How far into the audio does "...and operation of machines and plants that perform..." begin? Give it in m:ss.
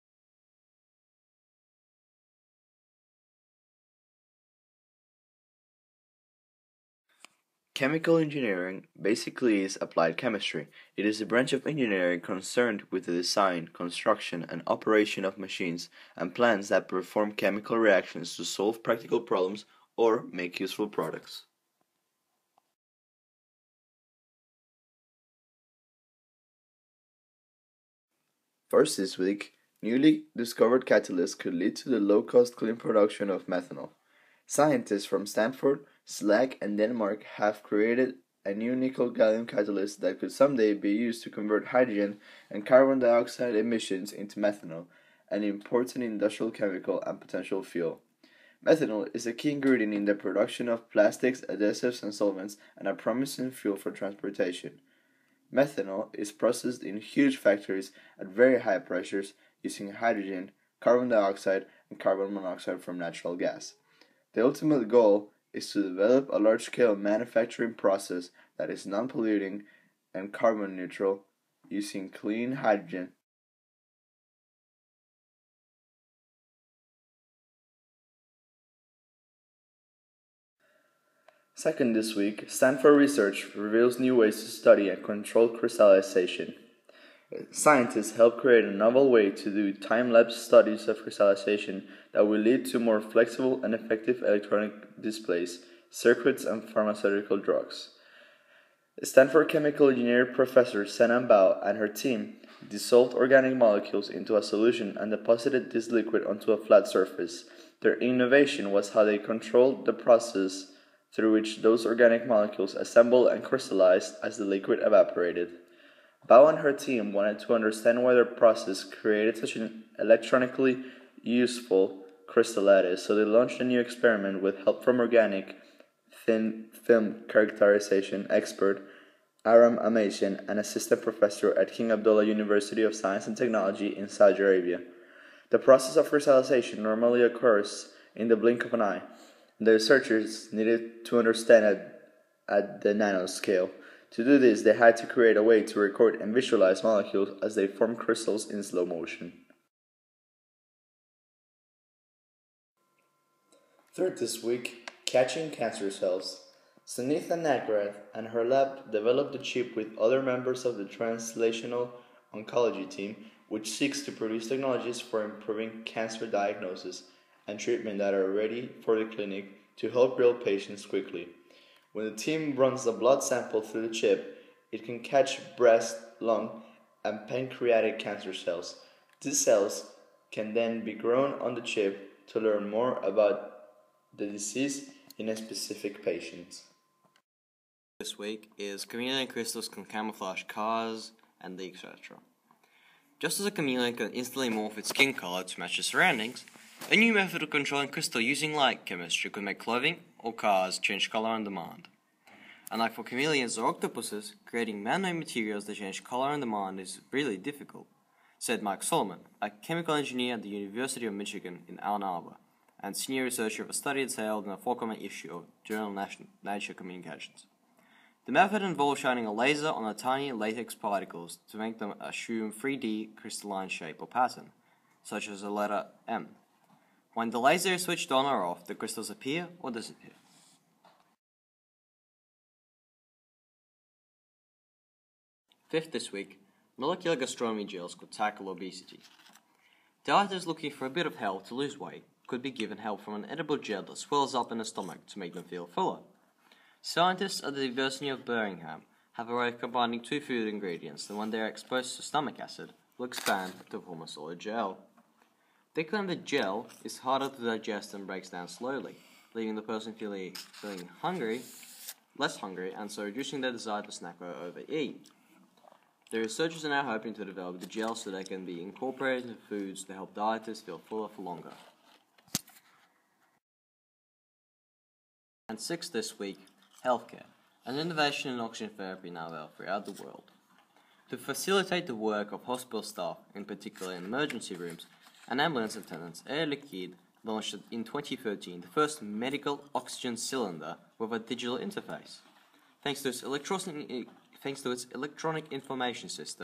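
0:14.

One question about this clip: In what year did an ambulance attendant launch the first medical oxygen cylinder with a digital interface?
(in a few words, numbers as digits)
2013.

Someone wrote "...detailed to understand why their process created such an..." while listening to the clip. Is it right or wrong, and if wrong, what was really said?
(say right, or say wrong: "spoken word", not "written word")
wrong: "wanted", not "detailed".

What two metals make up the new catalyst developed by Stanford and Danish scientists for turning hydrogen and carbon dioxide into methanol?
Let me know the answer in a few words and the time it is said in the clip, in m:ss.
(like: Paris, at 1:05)
nickel gallium, at 0:38.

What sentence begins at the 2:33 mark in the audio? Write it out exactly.
Third this week, catching cancer cells.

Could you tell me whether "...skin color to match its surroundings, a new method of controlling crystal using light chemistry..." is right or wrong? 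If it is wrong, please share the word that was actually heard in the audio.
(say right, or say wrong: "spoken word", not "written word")
right.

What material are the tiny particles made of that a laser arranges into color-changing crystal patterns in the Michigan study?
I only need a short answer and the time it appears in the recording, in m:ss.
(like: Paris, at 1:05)
latex, at 3:40.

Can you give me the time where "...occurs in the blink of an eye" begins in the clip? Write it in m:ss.
2:17.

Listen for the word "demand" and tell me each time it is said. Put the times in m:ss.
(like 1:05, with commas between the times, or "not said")
3:21, 3:26.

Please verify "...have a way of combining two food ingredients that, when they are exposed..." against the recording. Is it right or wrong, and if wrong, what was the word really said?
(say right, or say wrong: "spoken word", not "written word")
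right.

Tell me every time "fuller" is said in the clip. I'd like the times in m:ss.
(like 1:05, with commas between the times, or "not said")
4:05, 4:30.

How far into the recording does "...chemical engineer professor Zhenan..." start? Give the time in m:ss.
1:39.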